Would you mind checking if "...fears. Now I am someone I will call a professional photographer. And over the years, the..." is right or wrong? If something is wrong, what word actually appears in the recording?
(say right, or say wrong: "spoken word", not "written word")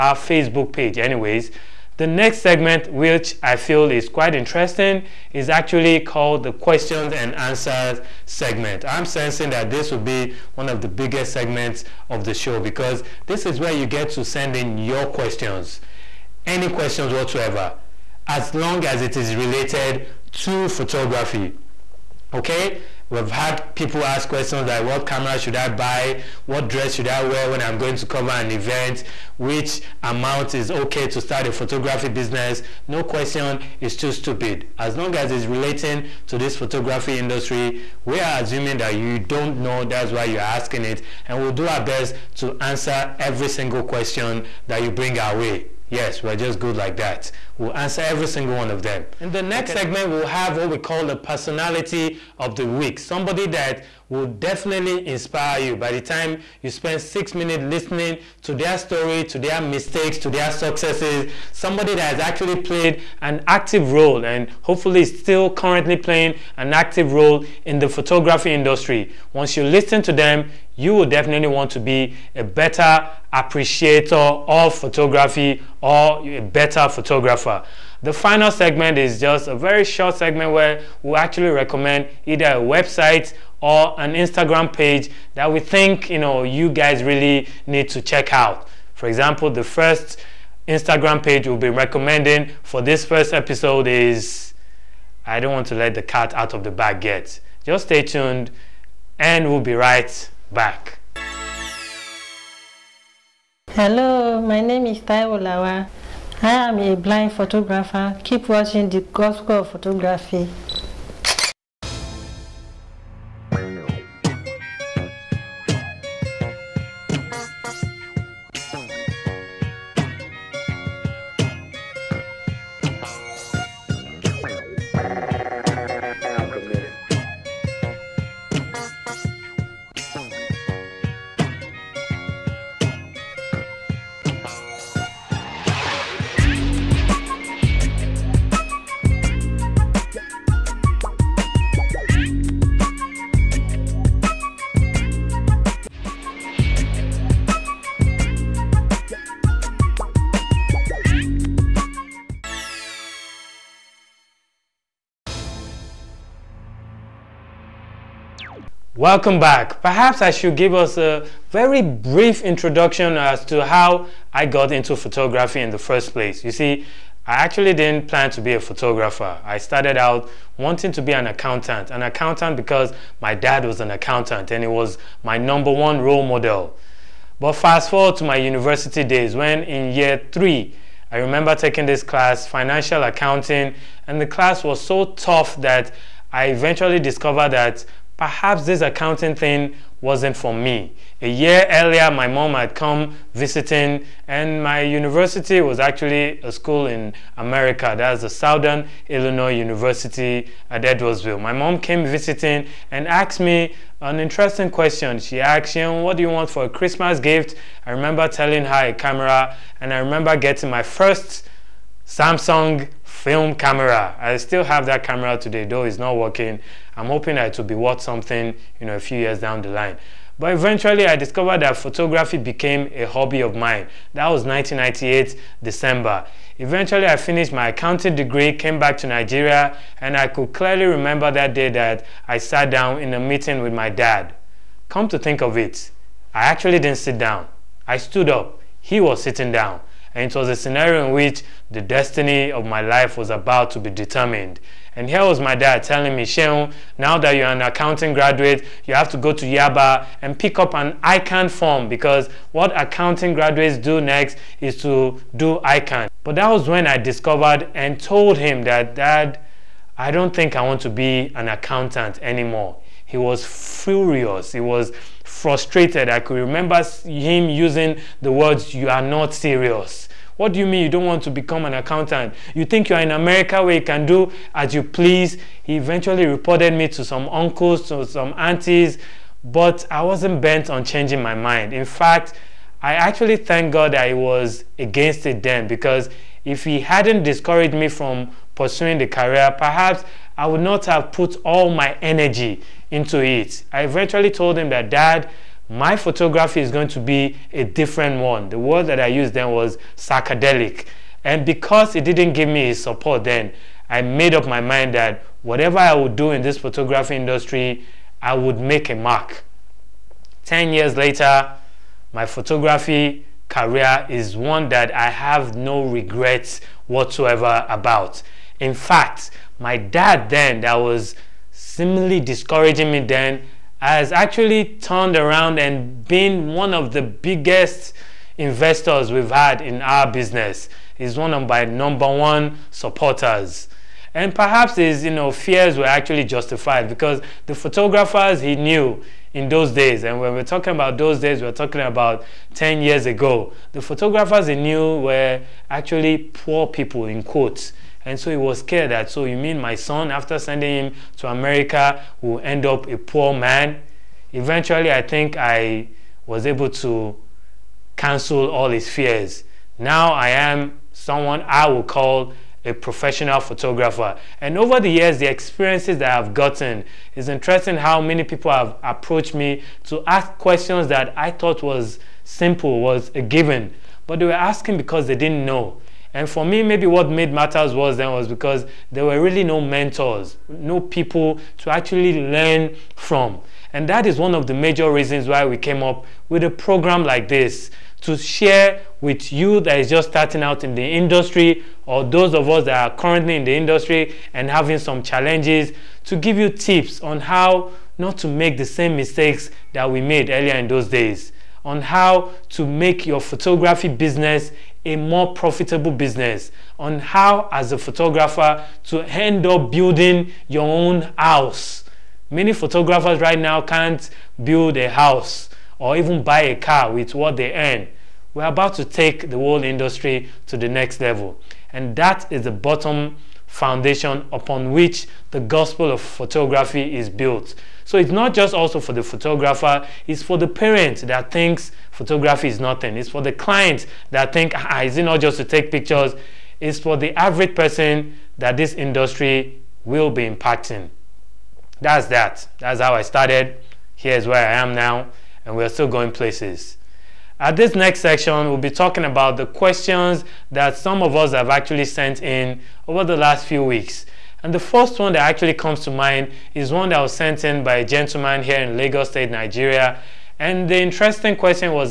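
right.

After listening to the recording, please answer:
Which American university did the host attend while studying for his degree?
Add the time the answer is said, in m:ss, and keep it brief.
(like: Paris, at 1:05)
Southern Illinois University at Edwardsville, at 3:18.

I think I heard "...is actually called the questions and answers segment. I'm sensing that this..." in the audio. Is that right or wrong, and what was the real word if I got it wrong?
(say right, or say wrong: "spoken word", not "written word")
right.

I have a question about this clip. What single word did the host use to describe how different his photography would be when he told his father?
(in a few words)
Psychedelic.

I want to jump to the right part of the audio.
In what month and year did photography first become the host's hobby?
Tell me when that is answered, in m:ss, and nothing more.
3:44.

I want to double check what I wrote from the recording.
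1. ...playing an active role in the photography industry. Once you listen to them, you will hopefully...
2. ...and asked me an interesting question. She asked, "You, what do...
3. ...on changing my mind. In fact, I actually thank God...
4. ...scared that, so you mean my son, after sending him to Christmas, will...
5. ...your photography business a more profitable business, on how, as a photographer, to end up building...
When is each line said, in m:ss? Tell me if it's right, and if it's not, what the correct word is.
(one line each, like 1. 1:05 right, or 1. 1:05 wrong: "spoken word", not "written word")
1. 1:05 wrong: "definitely", not "hopefully"
2. 3:22 right
3. 4:40 right
4. 5:48 wrong: "America", not "Christmas"
5. 6:43 right.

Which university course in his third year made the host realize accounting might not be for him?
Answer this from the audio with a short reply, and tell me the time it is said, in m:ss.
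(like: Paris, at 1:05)
Financial accounting, at 3:02.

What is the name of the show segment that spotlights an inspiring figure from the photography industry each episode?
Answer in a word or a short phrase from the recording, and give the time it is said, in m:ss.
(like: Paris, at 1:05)
Personality of the week, at 0:51.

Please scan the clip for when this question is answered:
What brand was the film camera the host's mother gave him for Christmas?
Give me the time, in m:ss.
3:32.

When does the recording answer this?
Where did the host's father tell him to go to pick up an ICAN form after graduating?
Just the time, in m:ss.
4:09.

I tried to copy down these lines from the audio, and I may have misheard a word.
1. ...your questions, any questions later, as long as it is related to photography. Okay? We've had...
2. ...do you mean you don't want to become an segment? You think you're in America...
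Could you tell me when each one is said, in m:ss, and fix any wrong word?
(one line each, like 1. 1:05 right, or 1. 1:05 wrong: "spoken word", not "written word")
1. 0:14 wrong: "whatsoever", not "later"
2. 4:30 wrong: "accountant", not "segment".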